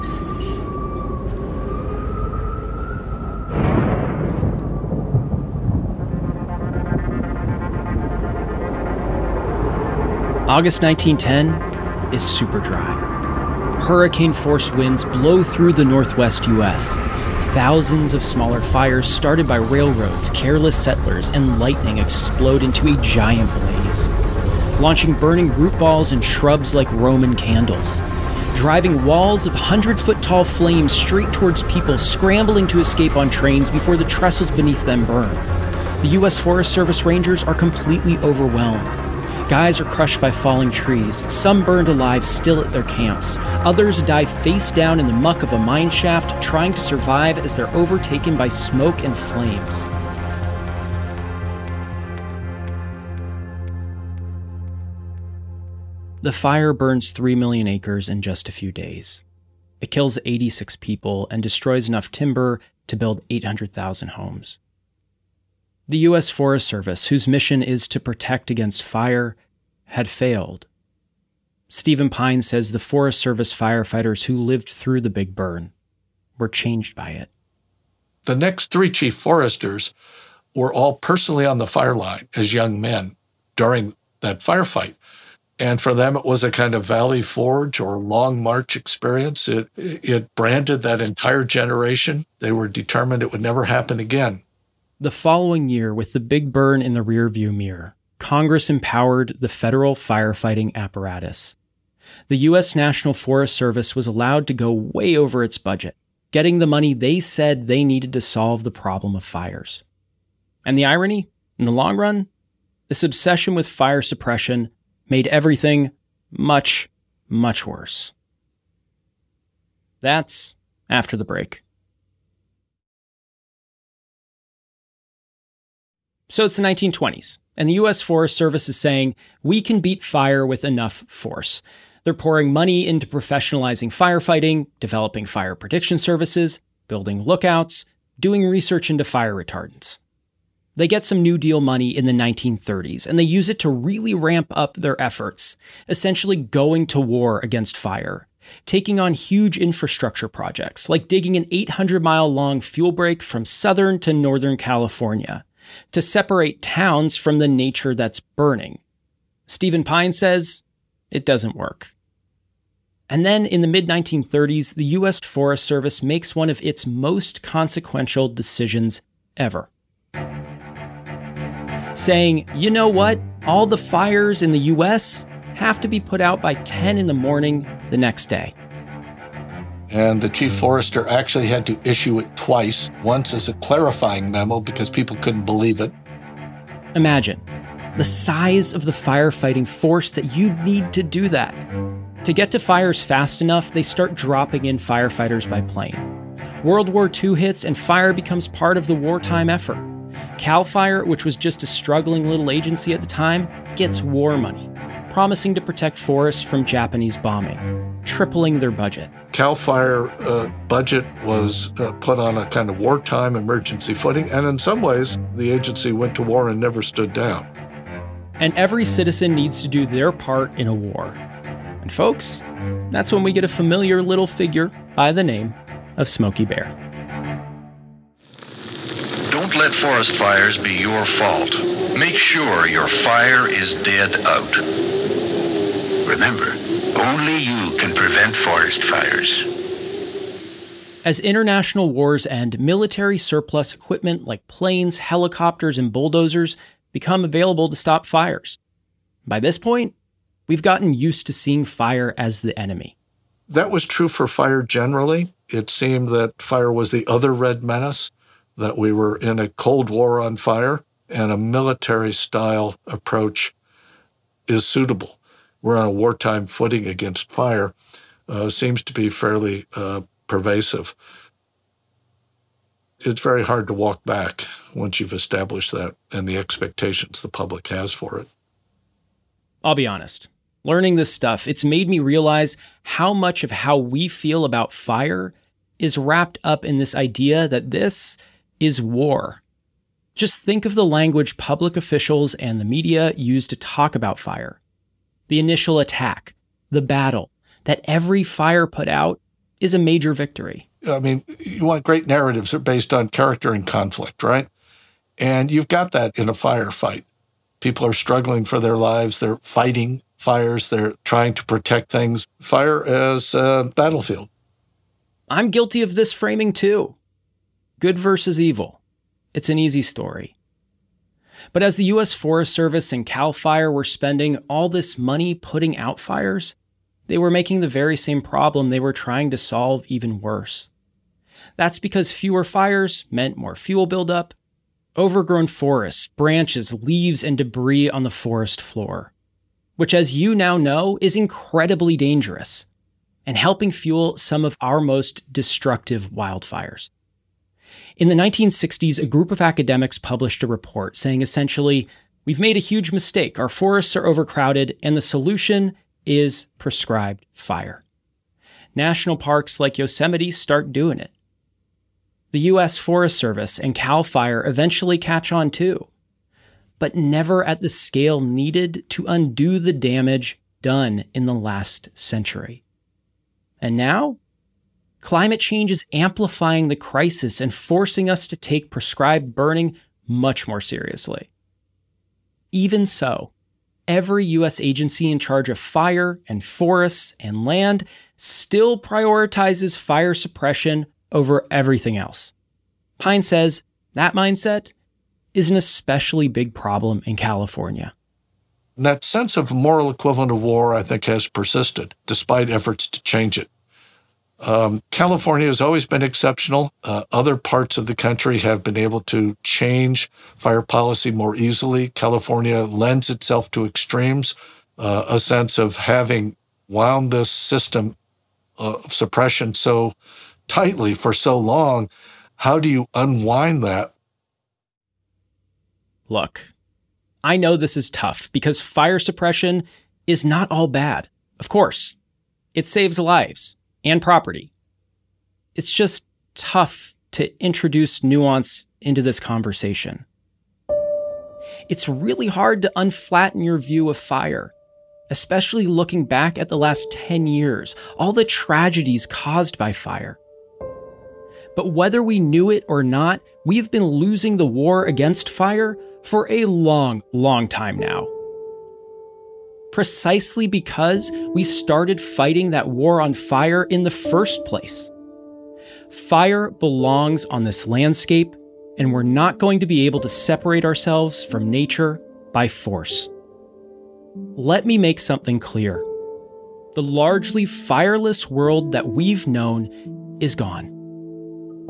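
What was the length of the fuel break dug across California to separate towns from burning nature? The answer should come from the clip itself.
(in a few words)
800 miles.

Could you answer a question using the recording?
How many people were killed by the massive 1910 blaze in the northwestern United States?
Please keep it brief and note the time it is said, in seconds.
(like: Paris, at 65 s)
86, at 60 s.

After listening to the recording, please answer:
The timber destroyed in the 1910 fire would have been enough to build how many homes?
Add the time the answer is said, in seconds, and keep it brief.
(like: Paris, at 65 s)
800,000, at 63 s.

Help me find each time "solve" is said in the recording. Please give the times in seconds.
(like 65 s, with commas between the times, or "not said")
108 s, 329 s.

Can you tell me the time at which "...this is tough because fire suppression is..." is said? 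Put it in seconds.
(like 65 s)
427 s.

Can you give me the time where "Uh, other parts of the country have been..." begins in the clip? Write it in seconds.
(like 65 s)
406 s.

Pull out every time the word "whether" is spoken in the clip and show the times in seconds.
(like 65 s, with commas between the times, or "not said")
451 s.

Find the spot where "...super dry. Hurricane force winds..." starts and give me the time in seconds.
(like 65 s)
12 s.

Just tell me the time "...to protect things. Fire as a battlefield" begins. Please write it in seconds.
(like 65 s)
311 s.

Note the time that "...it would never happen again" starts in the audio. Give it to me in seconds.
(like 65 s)
93 s.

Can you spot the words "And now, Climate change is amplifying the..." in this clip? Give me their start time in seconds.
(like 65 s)
373 s.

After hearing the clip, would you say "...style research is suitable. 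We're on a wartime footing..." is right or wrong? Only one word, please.
wrong.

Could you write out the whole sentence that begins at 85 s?
And for them, it was a kind of Valley Forge or Long March experience.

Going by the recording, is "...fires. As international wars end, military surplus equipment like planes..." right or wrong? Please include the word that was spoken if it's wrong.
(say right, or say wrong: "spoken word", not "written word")
right.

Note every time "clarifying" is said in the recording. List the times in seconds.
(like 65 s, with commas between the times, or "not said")
183 s.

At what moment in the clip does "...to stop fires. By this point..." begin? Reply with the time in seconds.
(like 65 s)
247 s.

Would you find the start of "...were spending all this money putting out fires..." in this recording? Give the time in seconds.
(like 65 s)
323 s.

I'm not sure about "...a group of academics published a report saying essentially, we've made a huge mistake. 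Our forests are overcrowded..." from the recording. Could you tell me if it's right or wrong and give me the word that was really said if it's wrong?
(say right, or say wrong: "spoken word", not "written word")
right.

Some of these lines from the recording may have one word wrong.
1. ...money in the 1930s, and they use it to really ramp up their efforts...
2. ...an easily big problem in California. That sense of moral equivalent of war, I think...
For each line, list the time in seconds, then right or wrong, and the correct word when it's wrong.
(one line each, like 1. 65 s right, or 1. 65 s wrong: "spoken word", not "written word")
1. 141 s right
2. 395 s wrong: "especially", not "easily".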